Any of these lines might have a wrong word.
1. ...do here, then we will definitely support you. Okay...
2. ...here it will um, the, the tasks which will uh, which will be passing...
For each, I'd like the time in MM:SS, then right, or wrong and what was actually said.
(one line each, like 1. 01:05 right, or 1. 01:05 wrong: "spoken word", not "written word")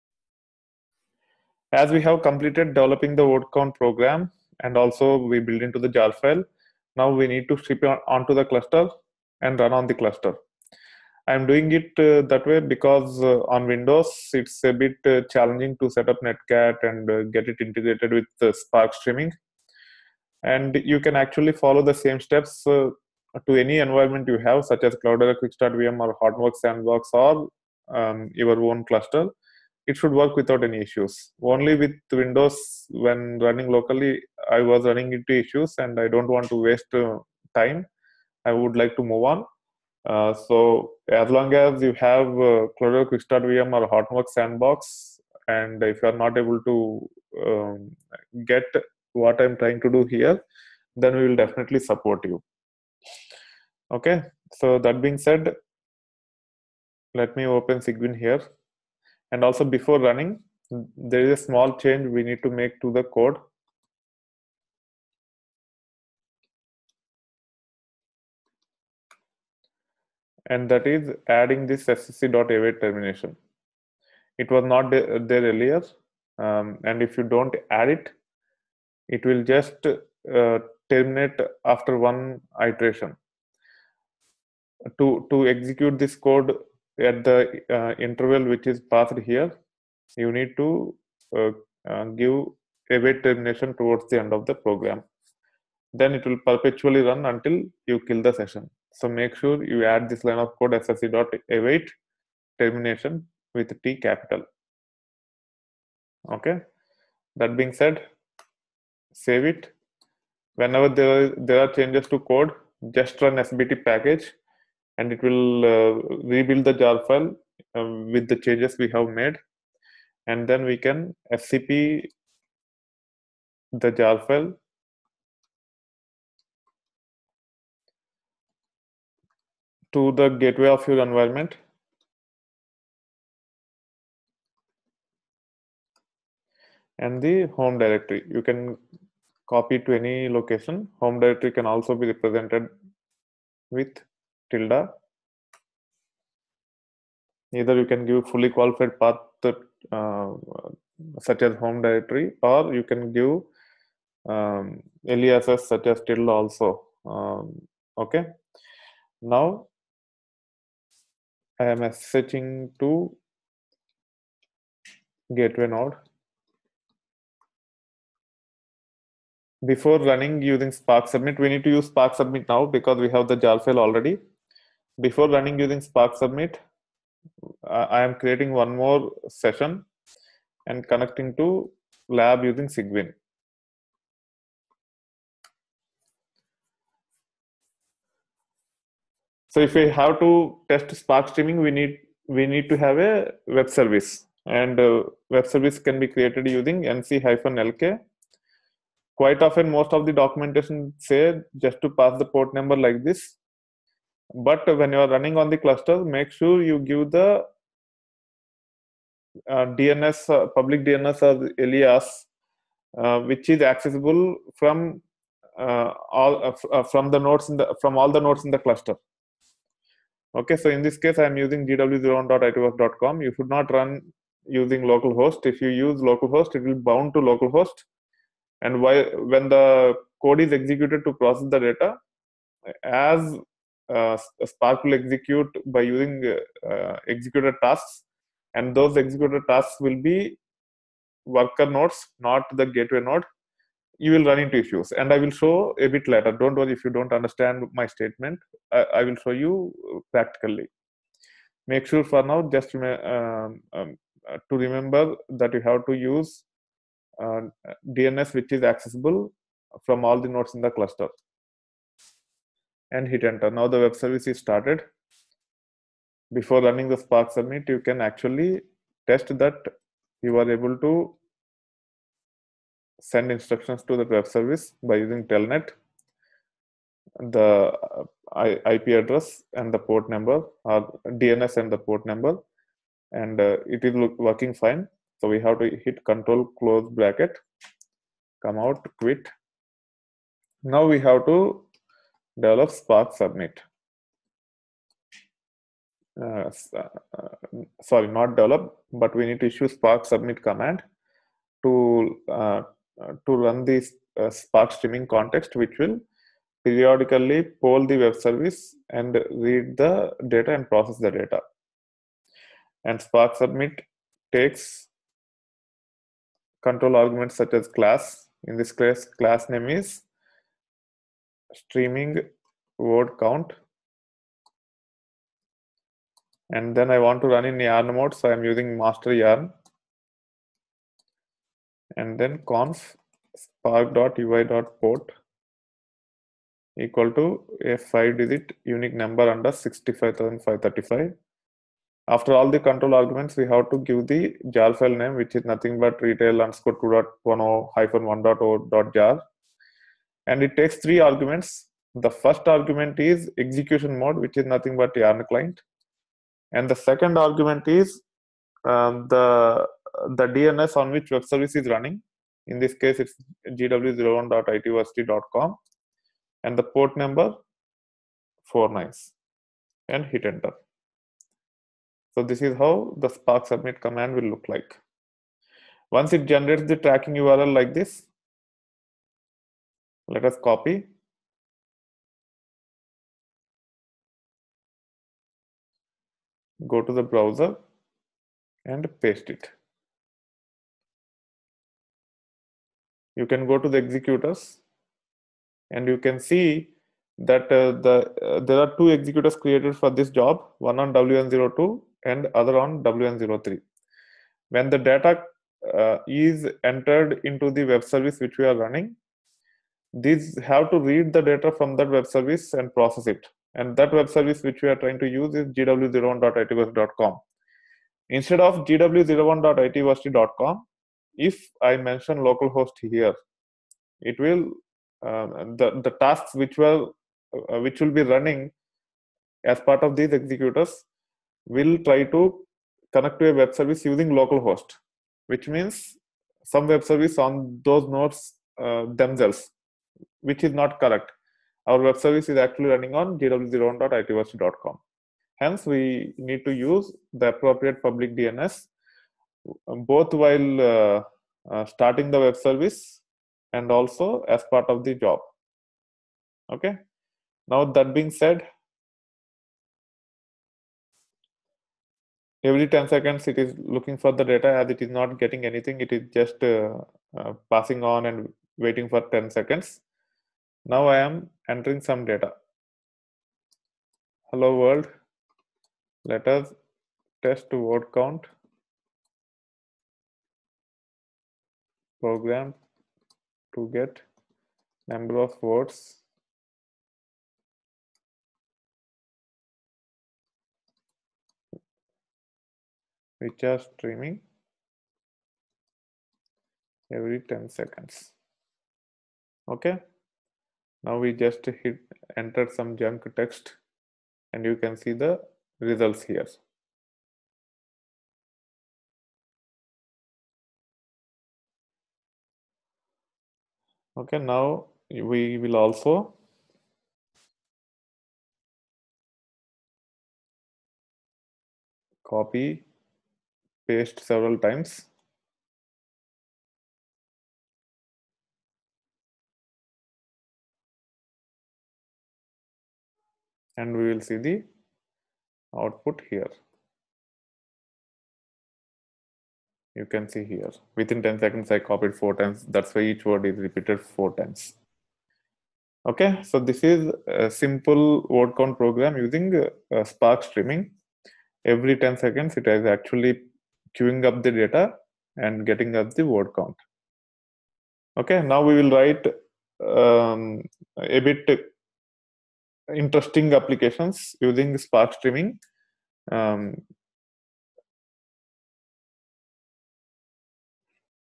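1. 00:49 right
2. 07:02 wrong: "running", not "passing".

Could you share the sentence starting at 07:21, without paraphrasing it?
Our web service is actually running on gw01.itversity.com.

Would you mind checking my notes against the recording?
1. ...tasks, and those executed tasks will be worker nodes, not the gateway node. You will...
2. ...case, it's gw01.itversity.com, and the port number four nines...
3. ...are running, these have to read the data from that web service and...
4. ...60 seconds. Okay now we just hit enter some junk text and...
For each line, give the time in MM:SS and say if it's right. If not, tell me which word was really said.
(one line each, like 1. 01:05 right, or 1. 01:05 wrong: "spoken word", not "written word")
1. 03:57 right
2. 06:02 right
3. 06:48 right
4. 08:17 wrong: "10", not "60".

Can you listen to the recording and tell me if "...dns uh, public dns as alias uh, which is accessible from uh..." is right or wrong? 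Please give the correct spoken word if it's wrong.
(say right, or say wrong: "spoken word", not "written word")
right.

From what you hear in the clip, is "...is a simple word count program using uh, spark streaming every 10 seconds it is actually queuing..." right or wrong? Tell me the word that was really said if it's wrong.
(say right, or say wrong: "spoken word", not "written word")
right.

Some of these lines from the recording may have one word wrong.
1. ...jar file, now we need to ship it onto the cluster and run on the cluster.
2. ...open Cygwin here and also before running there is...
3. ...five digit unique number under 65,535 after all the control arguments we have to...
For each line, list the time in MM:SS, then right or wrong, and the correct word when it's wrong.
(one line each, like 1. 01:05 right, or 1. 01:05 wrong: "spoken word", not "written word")
1. 00:05 right
2. 00:57 right
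3. 05:37 right.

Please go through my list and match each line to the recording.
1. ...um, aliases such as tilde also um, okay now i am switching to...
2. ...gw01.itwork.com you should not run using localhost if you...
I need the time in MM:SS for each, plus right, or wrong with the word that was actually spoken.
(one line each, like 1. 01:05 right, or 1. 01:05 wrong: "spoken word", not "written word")
1. 02:34 right
2. 03:41 right.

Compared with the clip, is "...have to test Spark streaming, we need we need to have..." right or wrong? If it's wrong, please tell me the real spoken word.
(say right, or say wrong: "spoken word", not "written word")
right.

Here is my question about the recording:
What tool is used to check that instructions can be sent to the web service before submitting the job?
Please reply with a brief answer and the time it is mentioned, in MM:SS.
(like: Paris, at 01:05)
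telnet, at 04:35.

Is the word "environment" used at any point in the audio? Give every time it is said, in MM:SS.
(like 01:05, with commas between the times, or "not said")
00:23, 02:10.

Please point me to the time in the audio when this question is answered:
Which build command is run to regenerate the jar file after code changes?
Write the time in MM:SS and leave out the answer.
01:53.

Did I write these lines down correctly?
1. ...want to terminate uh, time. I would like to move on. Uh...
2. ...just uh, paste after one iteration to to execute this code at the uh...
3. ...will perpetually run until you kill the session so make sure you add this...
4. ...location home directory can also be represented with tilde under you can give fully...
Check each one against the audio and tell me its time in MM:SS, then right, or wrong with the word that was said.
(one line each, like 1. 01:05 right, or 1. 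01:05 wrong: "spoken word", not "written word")
1. 00:36 wrong: "waste", not "terminate"
2. 01:19 wrong: "terminate", not "paste"
3. 01:36 right
4. 02:20 wrong: "either", not "under".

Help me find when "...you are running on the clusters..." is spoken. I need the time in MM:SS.
03:24.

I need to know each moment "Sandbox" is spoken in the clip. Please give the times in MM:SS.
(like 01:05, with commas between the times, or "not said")
00:26, 00:44.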